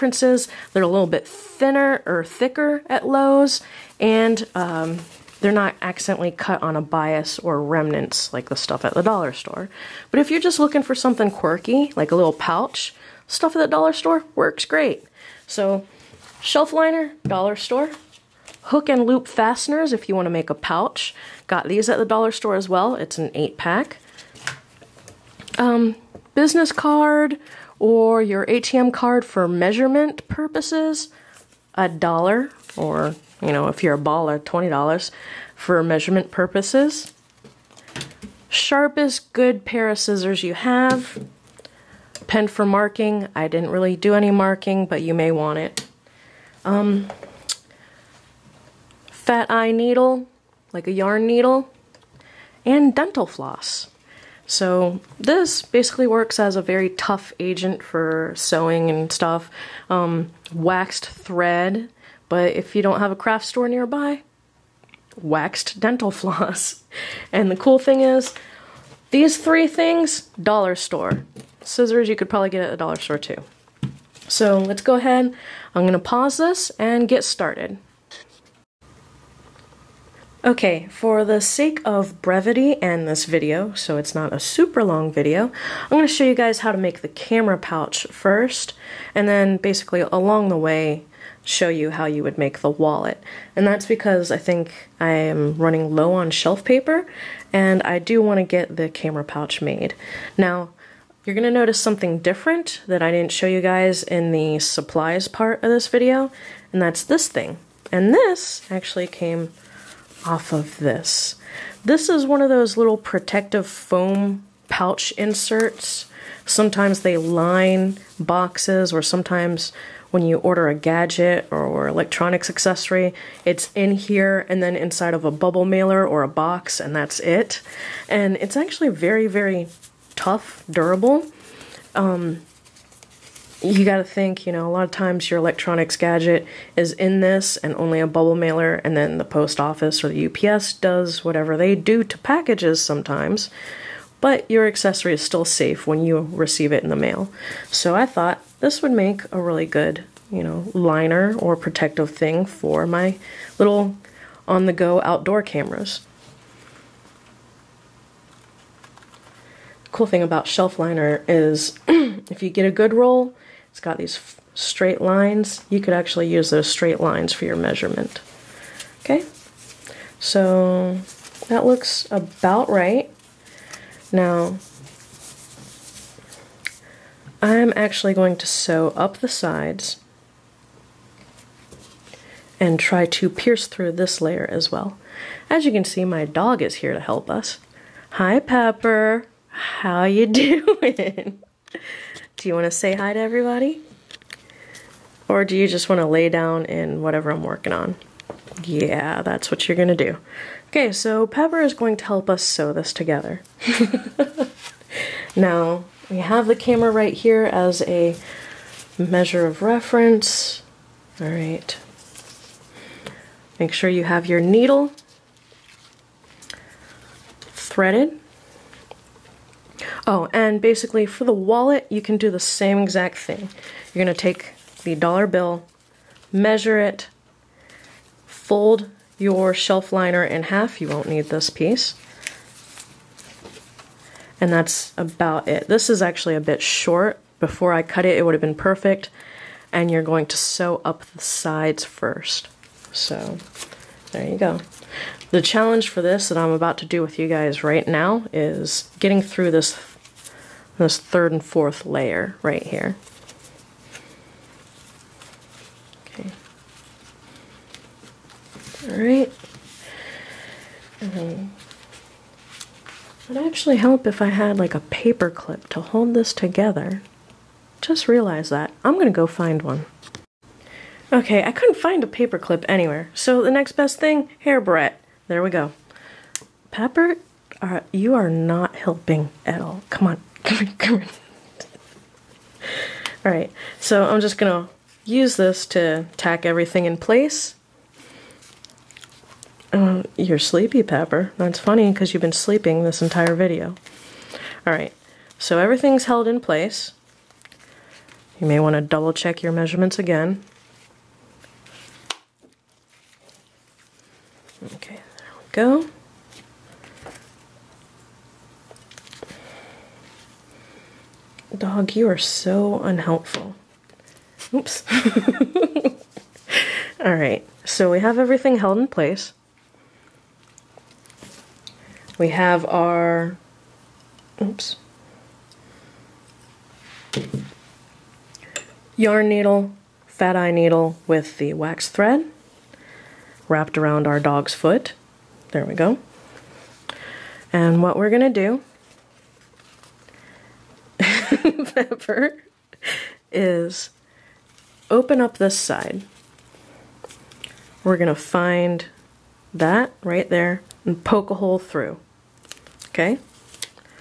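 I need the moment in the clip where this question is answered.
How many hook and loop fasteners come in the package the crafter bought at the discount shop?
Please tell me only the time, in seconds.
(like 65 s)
23 s.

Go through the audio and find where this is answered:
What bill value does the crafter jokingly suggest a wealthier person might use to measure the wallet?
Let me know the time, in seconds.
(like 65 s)
34 s.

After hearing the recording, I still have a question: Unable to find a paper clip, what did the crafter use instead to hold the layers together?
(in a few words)
Hair barrette.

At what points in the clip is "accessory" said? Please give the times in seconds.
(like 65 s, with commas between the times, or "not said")
122 s, 144 s.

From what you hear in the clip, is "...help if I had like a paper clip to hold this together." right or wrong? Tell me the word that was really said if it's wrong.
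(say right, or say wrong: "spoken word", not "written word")
right.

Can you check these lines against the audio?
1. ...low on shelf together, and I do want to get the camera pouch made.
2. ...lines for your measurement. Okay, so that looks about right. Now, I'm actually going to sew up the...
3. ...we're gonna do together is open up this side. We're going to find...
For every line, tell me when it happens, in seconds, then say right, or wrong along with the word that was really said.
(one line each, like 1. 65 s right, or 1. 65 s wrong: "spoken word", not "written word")
1. 95 s wrong: "paper", not "together"
2. 166 s right
3. 337 s wrong: "whatever", not "together".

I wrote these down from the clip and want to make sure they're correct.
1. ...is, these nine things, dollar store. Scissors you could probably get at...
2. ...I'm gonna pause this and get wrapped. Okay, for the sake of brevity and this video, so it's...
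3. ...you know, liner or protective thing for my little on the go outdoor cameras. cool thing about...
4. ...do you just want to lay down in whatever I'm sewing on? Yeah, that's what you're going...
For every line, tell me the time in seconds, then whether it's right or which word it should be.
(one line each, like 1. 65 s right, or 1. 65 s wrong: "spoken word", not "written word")
1. 67 s wrong: "three", not "nine"
2. 75 s wrong: "started", not "wrapped"
3. 150 s right
4. 195 s wrong: "working", not "sewing".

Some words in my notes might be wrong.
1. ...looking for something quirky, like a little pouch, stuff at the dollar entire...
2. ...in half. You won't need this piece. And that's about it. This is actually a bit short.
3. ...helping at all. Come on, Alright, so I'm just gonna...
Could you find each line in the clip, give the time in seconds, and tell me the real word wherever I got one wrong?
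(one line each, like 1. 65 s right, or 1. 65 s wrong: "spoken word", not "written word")
1. 10 s wrong: "store", not "entire"
2. 230 s right
3. 278 s right.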